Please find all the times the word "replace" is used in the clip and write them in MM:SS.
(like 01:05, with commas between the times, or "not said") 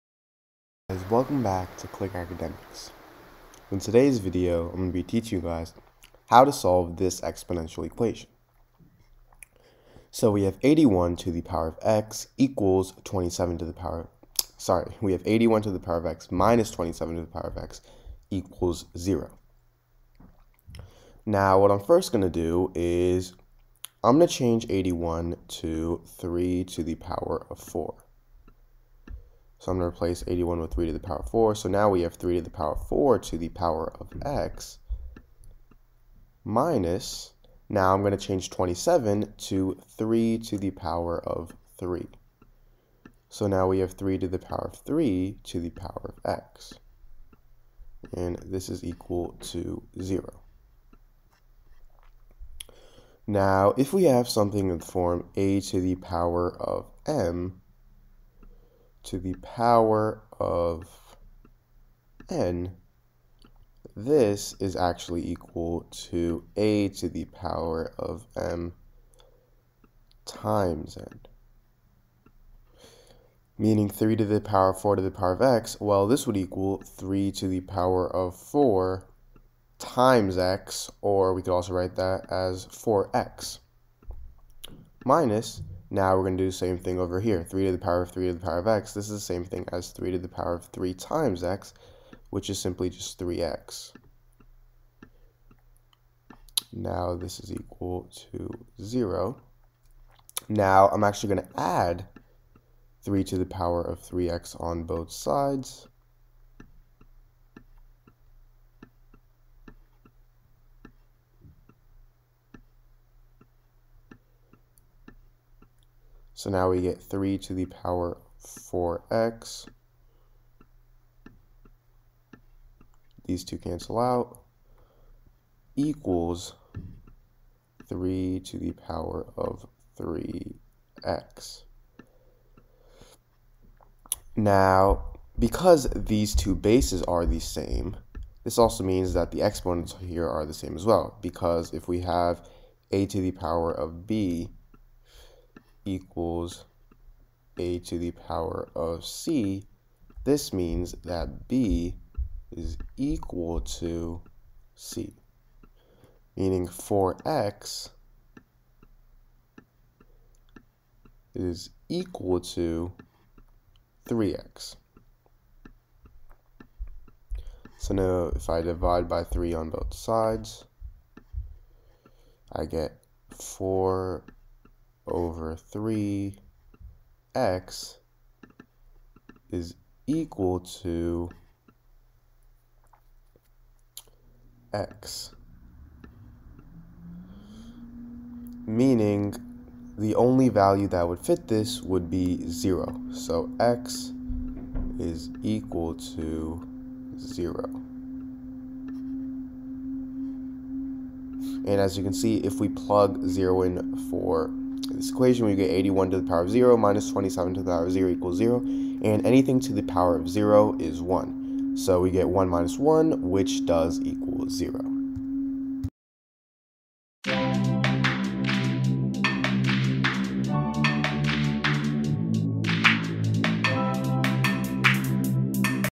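00:29.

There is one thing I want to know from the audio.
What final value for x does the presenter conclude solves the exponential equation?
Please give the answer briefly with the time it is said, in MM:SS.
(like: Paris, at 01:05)
0, at 03:13.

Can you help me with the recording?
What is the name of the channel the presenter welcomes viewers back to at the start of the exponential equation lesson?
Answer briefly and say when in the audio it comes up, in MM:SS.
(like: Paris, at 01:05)
Click Academics, at 00:01.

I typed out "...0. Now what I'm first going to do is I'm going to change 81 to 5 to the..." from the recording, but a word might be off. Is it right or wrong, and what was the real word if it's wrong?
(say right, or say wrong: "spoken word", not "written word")
wrong: "3", not "5".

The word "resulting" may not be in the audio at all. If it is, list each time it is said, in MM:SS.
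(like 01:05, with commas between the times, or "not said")
not said.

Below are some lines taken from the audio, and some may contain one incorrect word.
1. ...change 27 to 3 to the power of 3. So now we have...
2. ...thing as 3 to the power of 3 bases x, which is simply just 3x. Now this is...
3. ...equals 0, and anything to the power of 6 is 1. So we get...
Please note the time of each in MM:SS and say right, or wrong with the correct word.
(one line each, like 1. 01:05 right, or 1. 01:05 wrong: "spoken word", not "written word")
1. 00:38 right
2. 01:29 wrong: "times", not "bases"
3. 03:28 wrong: "0", not "6".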